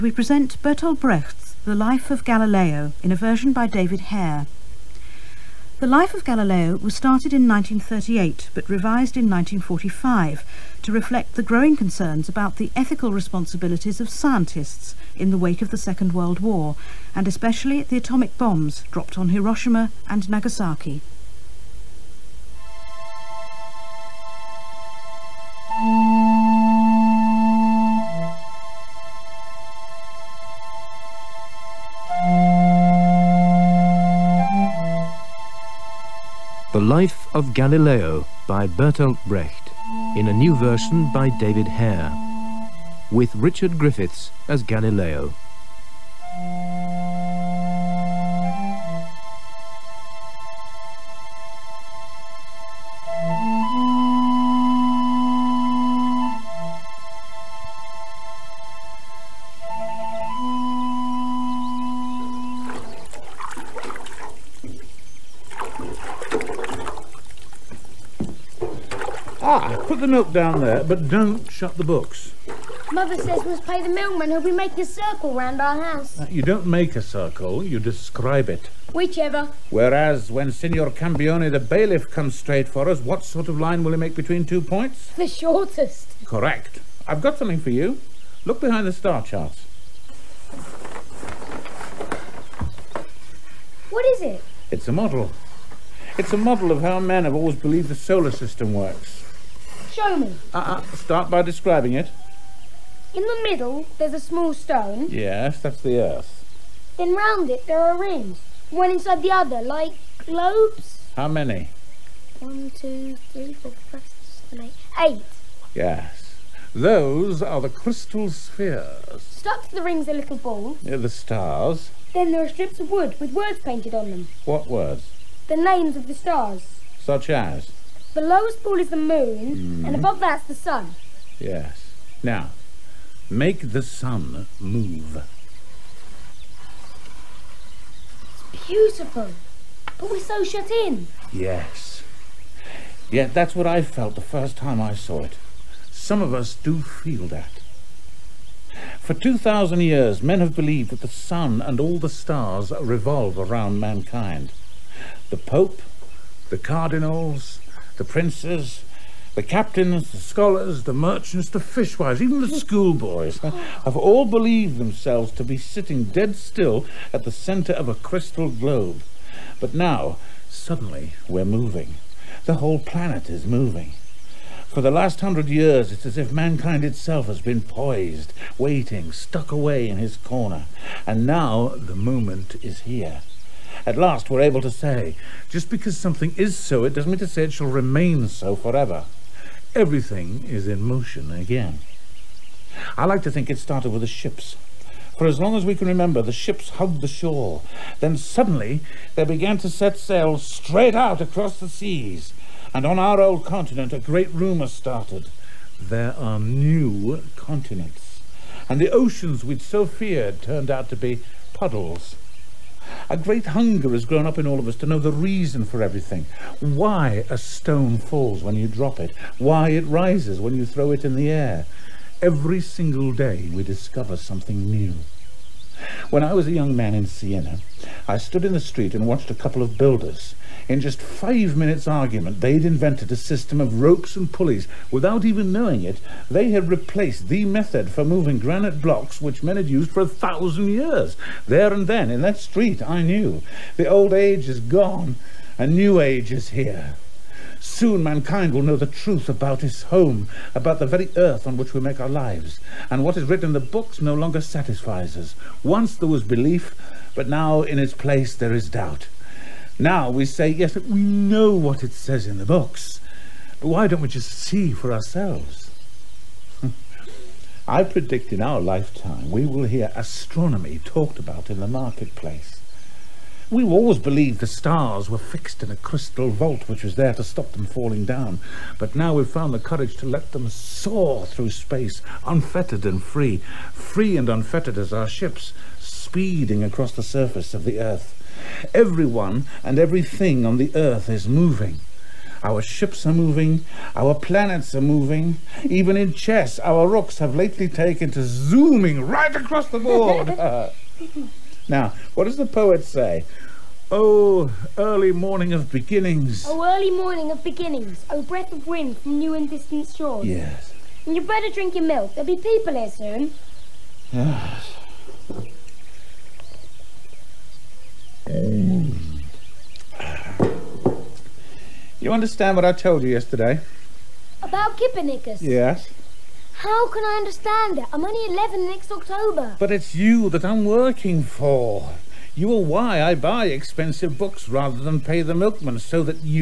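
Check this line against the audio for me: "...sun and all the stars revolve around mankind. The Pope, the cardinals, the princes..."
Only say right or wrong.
right.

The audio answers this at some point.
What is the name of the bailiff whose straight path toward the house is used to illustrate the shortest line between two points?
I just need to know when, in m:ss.
1:20.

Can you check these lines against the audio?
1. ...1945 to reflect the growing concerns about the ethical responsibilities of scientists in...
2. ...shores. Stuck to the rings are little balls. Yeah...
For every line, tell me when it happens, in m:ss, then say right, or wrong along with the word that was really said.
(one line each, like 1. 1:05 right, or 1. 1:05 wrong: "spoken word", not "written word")
1. 0:09 right
2. 1:58 wrong: "spheres", not "shores".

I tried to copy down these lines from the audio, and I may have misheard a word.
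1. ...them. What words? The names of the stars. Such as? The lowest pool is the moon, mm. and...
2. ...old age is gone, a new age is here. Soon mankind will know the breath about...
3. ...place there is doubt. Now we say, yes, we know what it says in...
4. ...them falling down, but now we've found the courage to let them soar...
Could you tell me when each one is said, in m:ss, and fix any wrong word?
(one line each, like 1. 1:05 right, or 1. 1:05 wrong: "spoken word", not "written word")
1. 2:04 right
2. 4:03 wrong: "truth", not "breath"
3. 4:17 right
4. 4:37 right.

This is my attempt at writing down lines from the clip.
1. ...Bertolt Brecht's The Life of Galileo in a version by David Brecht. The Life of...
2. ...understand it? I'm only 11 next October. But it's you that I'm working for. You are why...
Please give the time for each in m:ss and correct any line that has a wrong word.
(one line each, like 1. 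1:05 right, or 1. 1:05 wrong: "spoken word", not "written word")
1. 0:00 wrong: "Hare", not "Brecht"
2. 5:27 right.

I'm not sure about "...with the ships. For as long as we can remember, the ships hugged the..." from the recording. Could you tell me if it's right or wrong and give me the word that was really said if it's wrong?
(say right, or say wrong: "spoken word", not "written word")
right.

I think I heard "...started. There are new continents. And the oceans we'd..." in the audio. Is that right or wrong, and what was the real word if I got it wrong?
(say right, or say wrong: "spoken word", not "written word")
right.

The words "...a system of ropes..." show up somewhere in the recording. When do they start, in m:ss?
3:53.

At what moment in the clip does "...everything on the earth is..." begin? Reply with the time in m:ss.
4:49.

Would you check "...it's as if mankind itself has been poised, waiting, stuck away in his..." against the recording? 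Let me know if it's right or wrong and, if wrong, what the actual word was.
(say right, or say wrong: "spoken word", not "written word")
right.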